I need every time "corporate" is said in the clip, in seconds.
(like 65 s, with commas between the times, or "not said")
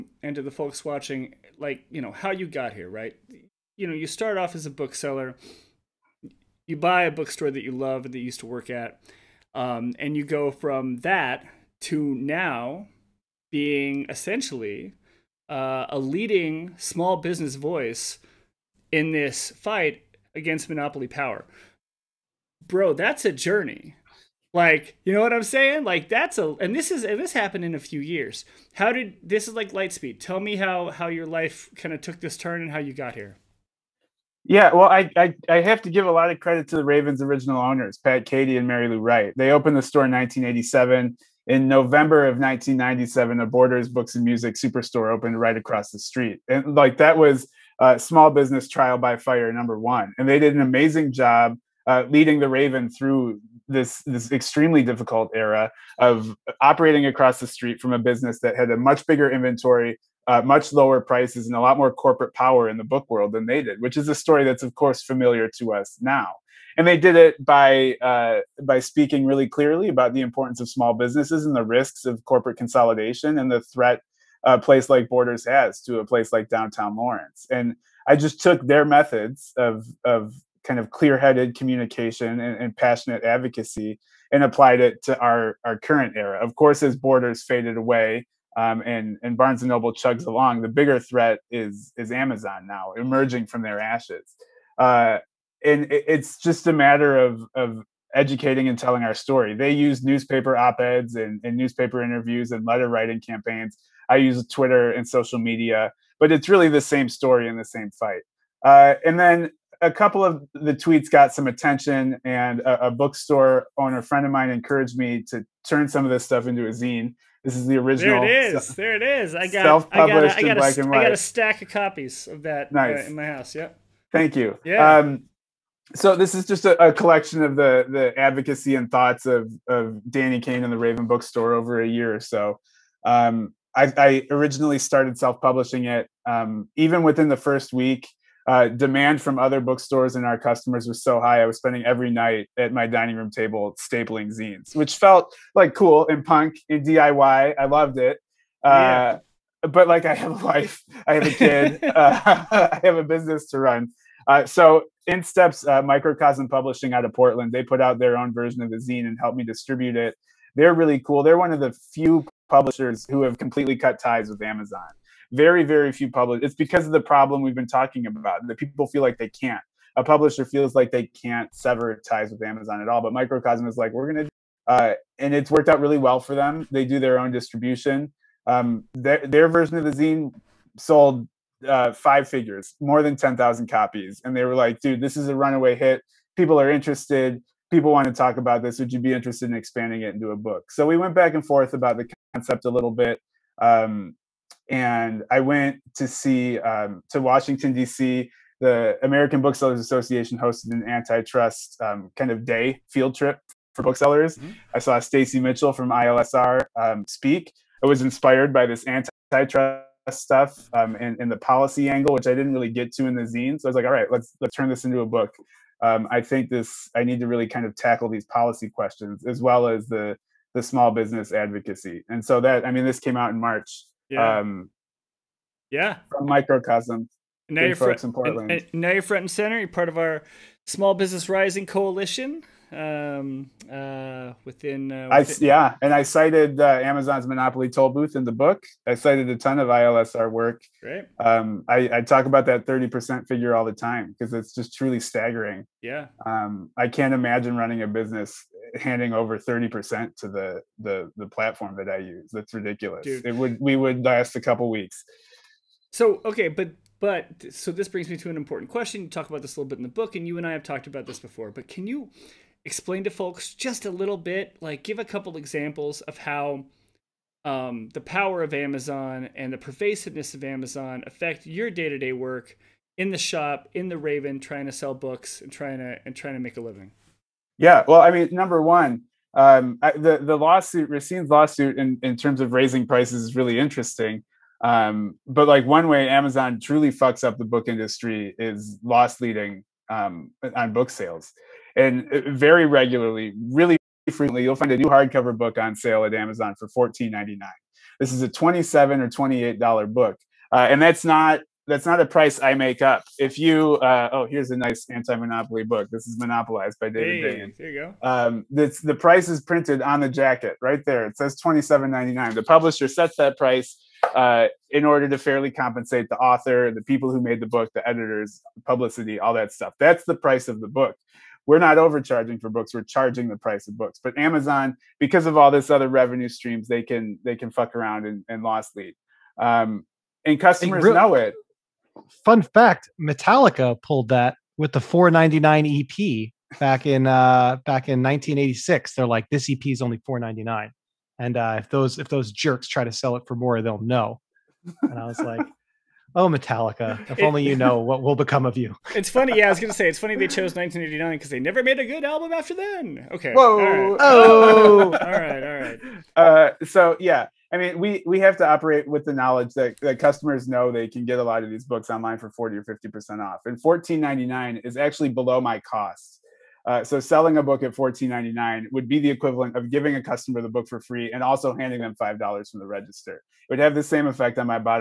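61 s, 72 s.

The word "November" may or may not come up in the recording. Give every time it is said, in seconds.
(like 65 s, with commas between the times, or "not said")
41 s.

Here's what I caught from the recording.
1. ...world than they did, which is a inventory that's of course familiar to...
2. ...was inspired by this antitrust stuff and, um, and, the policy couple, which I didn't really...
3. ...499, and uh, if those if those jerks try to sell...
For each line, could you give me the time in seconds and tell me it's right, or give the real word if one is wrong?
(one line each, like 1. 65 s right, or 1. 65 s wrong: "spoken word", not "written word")
1. 63 s wrong: "story", not "inventory"
2. 207 s wrong: "angle", not "couple"
3. 340 s right.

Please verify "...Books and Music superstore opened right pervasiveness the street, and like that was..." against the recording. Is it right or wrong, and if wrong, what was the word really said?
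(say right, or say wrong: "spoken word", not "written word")
wrong: "across", not "pervasiveness".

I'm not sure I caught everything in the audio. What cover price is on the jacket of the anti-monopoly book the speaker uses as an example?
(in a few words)
$27.99.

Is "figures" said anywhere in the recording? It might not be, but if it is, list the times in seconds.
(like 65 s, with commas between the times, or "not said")
182 s, 243 s.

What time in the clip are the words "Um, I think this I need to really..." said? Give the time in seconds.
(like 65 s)
215 s.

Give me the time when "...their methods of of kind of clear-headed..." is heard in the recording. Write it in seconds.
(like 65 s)
78 s.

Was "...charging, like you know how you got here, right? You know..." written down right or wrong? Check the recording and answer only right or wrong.
wrong.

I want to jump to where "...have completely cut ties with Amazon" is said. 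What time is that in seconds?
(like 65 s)
163 s.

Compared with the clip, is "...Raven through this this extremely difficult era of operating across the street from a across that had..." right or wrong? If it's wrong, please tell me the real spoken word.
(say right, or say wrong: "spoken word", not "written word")
wrong: "business", not "across".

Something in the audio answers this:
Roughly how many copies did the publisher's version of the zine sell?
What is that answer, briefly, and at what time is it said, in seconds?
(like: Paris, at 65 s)
more than 10,000, at 182 s.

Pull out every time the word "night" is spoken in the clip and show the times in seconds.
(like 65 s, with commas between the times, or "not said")
142 s.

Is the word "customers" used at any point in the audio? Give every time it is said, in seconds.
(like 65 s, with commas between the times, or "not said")
140 s, 330 s, 359 s, 370 s.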